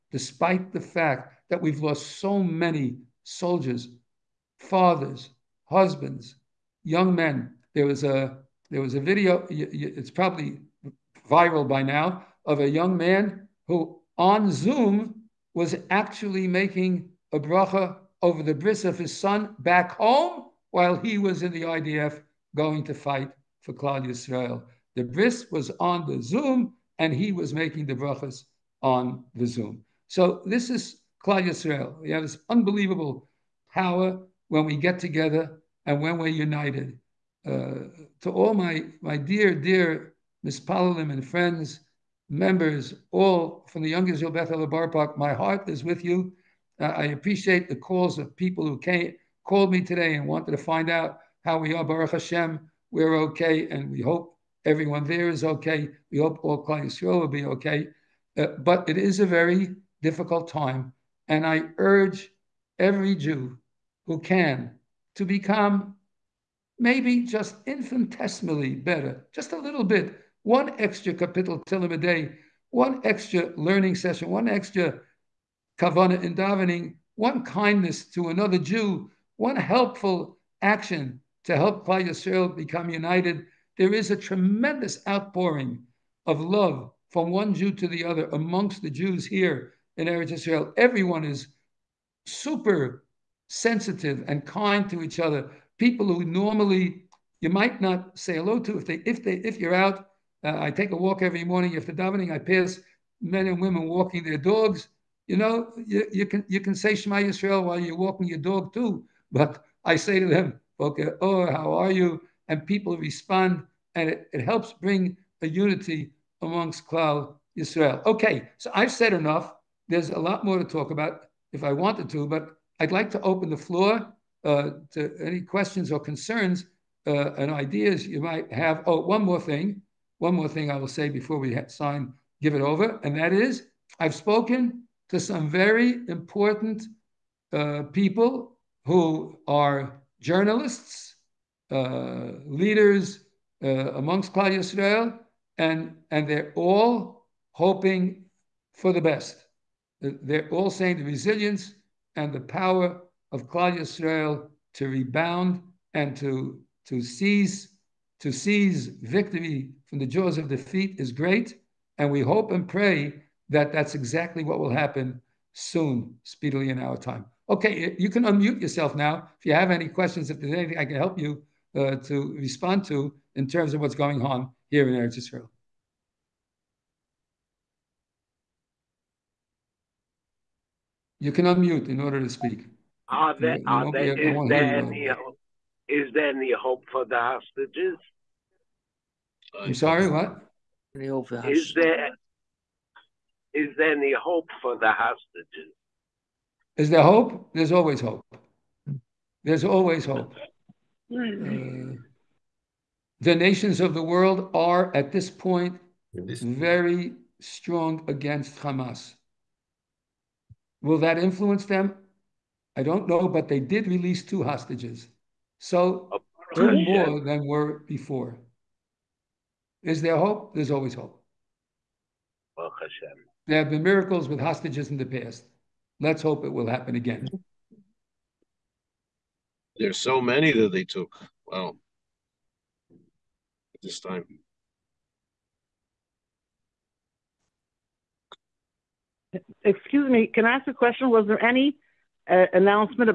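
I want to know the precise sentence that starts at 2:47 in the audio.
Okay, you can unmute yourself now if you have any questions.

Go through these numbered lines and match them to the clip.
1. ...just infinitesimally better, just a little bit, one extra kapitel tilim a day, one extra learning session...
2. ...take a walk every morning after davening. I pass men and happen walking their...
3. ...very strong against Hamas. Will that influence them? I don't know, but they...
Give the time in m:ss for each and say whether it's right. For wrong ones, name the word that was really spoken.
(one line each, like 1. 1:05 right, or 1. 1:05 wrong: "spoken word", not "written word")
1. 1:07 right
2. 1:40 wrong: "women", not "happen"
3. 3:26 right.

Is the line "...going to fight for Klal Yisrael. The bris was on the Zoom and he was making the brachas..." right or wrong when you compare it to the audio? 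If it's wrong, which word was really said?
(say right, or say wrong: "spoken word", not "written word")
right.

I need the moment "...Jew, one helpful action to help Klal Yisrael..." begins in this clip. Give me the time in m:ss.
1:18.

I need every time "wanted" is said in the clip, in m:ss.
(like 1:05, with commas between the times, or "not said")
0:50, 2:01.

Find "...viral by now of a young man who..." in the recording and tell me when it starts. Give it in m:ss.
0:11.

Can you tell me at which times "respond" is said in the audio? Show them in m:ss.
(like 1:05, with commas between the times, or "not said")
1:52, 2:52.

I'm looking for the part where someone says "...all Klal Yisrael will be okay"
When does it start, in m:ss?
0:56.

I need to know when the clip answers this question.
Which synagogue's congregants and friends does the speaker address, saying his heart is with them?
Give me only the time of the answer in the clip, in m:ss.
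0:43.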